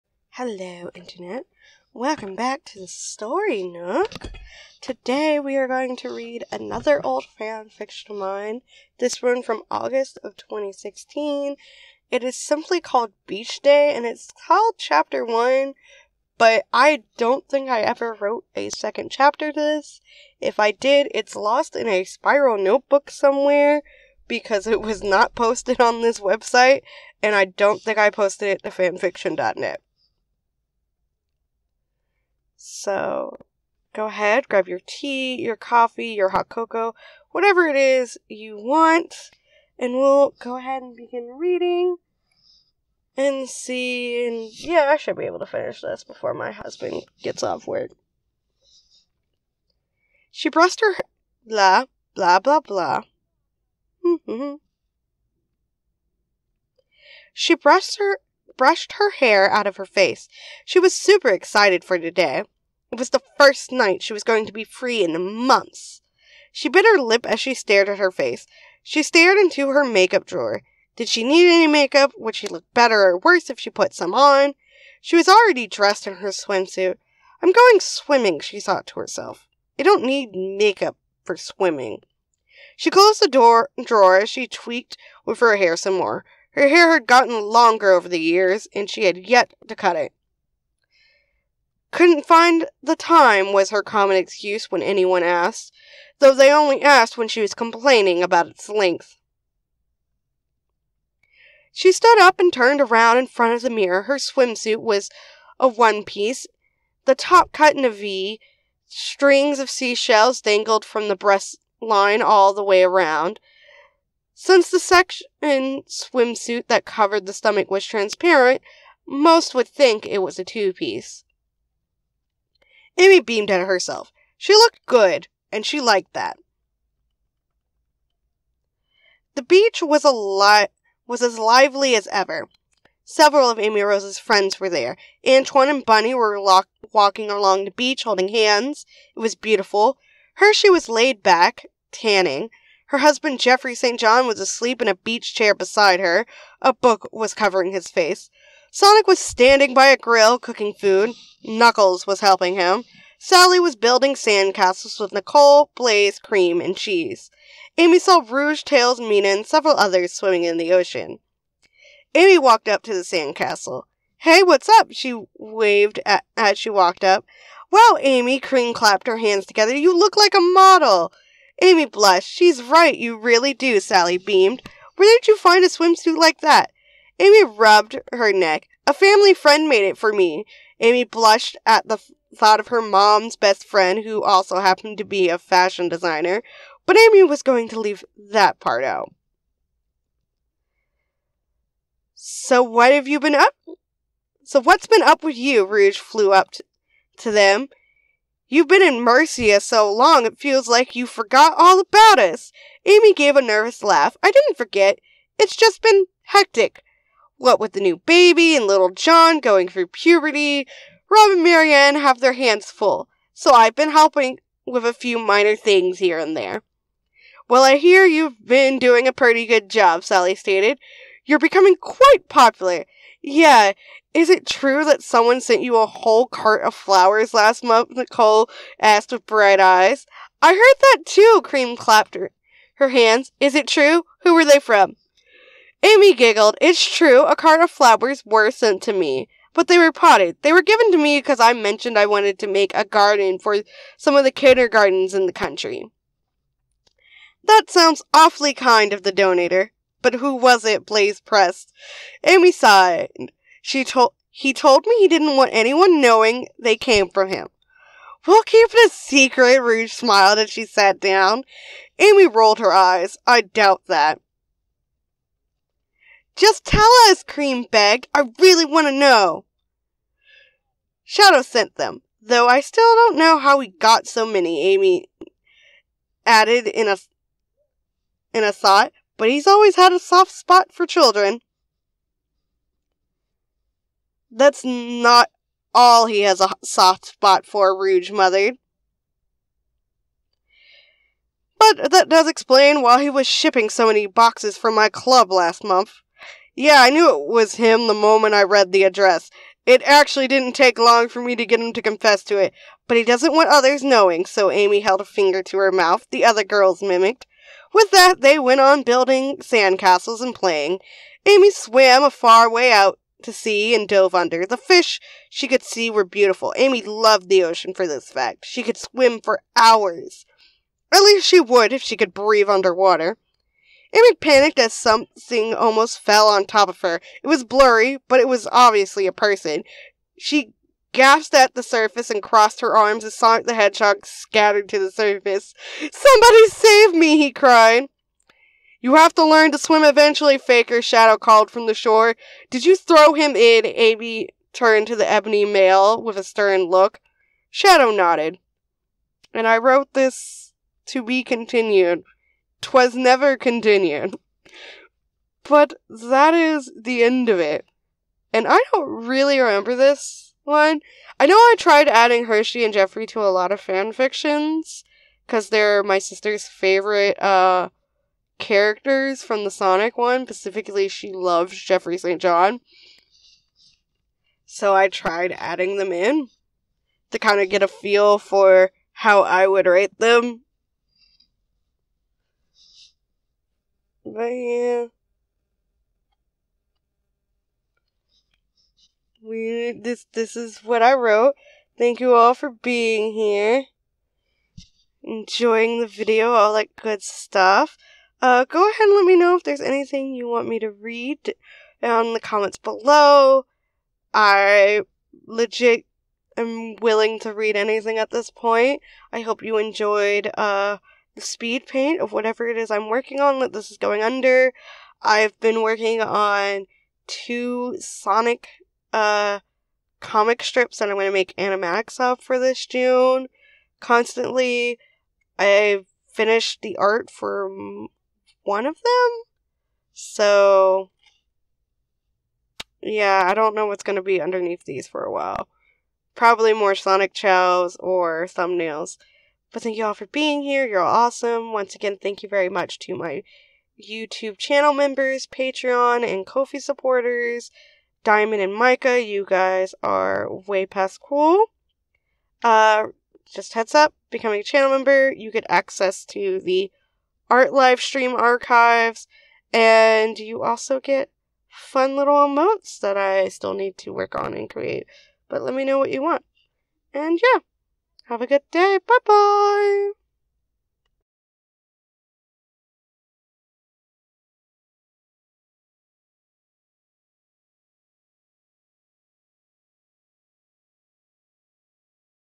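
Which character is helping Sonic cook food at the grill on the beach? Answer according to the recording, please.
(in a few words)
Knuckles.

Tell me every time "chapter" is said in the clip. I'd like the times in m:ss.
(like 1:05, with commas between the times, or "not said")
0:14, 0:19.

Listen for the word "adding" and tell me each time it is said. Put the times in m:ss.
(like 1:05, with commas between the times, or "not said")
6:01, 6:15.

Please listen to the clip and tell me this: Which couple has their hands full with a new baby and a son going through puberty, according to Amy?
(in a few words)
Rob and Marianne.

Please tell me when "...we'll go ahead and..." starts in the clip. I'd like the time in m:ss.
0:39.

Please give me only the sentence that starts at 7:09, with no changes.
So, yeah, I don't know what's going to be underneath these for a while.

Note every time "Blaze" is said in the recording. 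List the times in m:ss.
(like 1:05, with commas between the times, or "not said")
2:35, 4:10.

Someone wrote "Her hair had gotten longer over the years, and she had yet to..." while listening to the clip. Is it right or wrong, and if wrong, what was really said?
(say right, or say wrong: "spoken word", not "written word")
right.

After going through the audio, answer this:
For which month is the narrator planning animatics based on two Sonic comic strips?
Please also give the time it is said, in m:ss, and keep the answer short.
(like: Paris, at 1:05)
June, at 7:02.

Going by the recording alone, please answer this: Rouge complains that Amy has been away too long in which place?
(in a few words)
Mercia.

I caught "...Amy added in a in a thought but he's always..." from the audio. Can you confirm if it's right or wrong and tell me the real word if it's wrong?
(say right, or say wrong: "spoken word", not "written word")
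right.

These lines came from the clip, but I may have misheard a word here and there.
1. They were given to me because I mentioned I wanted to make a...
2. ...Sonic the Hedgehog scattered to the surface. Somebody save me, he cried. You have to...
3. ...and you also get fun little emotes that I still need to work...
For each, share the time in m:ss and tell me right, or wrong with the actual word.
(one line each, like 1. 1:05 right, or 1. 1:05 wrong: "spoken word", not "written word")
1. 4:00 right
2. 5:33 right
3. 7:39 right.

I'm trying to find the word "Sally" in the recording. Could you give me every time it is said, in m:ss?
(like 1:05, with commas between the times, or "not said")
2:33, 2:53, 3:40.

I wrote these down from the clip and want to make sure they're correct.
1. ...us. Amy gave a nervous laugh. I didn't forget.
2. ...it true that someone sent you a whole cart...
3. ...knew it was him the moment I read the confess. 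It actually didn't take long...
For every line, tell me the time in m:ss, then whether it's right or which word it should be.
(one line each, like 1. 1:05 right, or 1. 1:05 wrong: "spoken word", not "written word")
1. 3:22 right
2. 3:44 right
3. 4:56 wrong: "address", not "confess".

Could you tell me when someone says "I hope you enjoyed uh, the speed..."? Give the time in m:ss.
6:49.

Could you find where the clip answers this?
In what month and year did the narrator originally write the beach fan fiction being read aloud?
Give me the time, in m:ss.
0:09.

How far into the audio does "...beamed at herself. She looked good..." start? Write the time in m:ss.
2:03.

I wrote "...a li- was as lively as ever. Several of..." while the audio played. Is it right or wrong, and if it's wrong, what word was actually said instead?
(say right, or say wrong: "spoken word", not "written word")
right.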